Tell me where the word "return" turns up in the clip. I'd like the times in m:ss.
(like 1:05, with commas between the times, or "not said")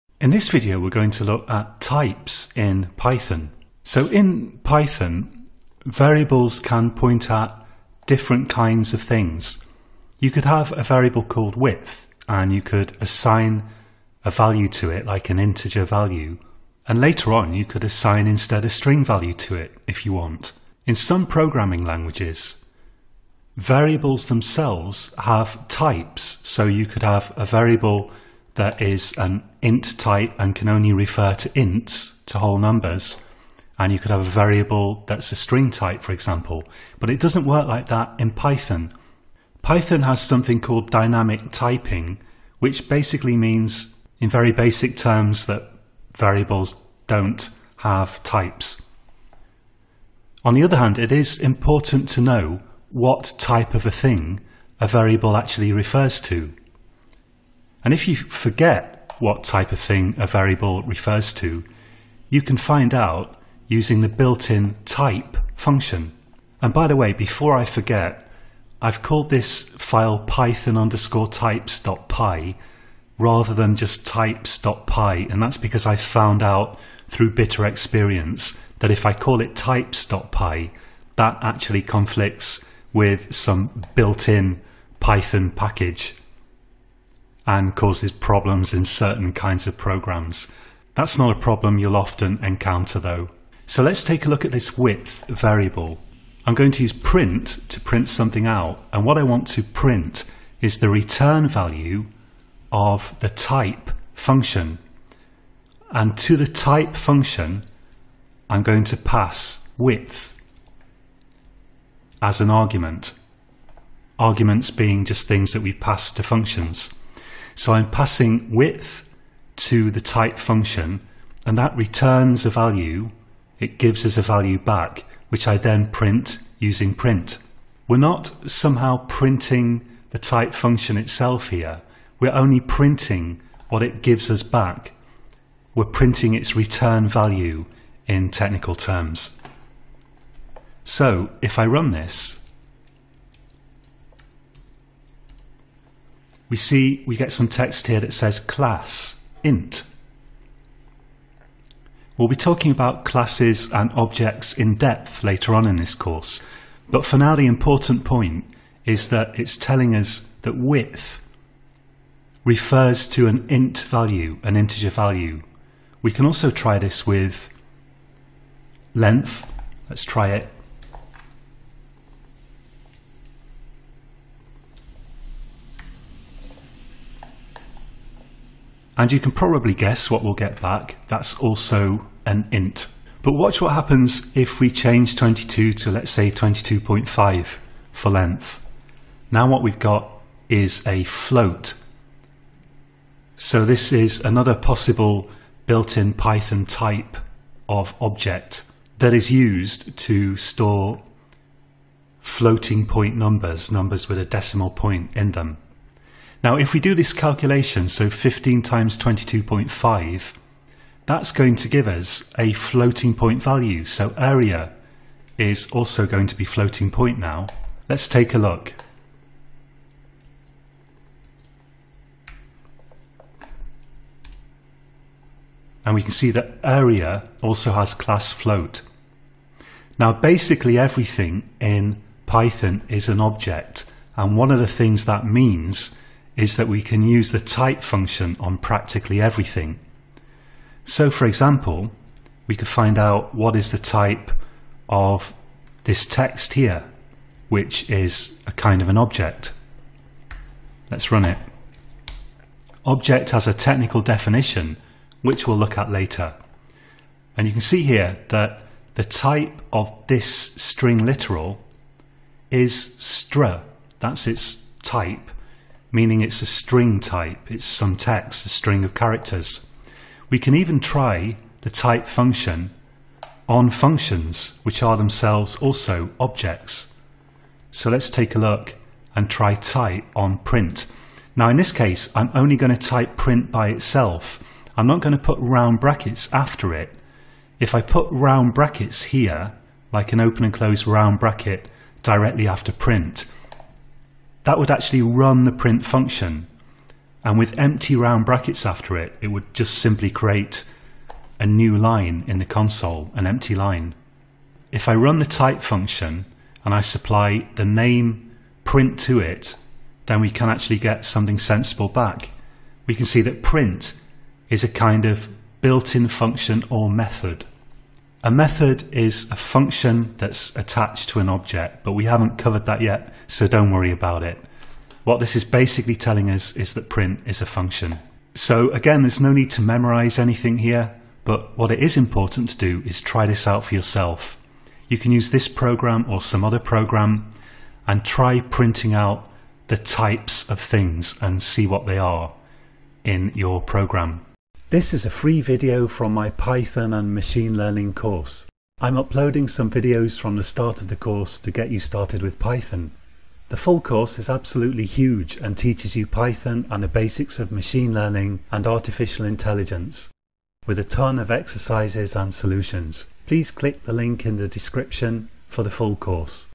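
1:40, 2:01, 2:16.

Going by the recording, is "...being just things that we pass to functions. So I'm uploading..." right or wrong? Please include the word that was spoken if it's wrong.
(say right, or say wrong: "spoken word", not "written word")
wrong: "passing", not "uploading".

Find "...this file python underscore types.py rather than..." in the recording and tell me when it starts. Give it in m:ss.
1:09.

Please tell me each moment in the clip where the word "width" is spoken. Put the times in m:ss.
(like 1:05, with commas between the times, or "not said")
0:11, 1:34, 1:49, 1:58, 2:40.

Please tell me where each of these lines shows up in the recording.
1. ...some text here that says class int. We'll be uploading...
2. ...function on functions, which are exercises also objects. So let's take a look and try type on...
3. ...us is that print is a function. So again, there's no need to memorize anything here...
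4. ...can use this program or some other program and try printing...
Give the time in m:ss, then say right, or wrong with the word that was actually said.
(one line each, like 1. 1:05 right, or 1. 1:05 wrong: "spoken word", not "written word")
1. 2:27 wrong: "talking", not "uploading"
2. 4:32 wrong: "themselves", not "exercises"
3. 5:26 right
4. 5:34 right.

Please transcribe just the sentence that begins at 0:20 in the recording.
In some programming languages, variables themselves have types.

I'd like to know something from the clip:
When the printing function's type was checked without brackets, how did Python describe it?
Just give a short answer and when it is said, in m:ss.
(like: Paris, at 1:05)
built-in function or method, at 5:15.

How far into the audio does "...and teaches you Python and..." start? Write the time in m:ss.
5:55.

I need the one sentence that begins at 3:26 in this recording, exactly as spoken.
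Now if we do this calculation, so 15 times 22.5, that's going to give us a floating point value.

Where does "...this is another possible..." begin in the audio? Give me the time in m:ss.
3:13.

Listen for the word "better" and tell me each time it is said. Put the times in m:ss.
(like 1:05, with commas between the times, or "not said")
not said.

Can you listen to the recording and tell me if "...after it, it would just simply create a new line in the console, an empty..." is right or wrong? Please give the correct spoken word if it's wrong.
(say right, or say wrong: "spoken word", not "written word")
right.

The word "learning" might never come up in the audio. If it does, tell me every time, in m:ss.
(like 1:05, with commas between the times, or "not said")
5:47, 5:57.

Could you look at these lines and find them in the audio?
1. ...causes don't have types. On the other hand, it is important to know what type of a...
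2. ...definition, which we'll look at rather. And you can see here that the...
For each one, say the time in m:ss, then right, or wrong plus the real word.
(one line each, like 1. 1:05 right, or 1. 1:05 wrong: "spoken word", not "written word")
1. 0:46 wrong: "variables", not "causes"
2. 4:14 wrong: "later", not "rather".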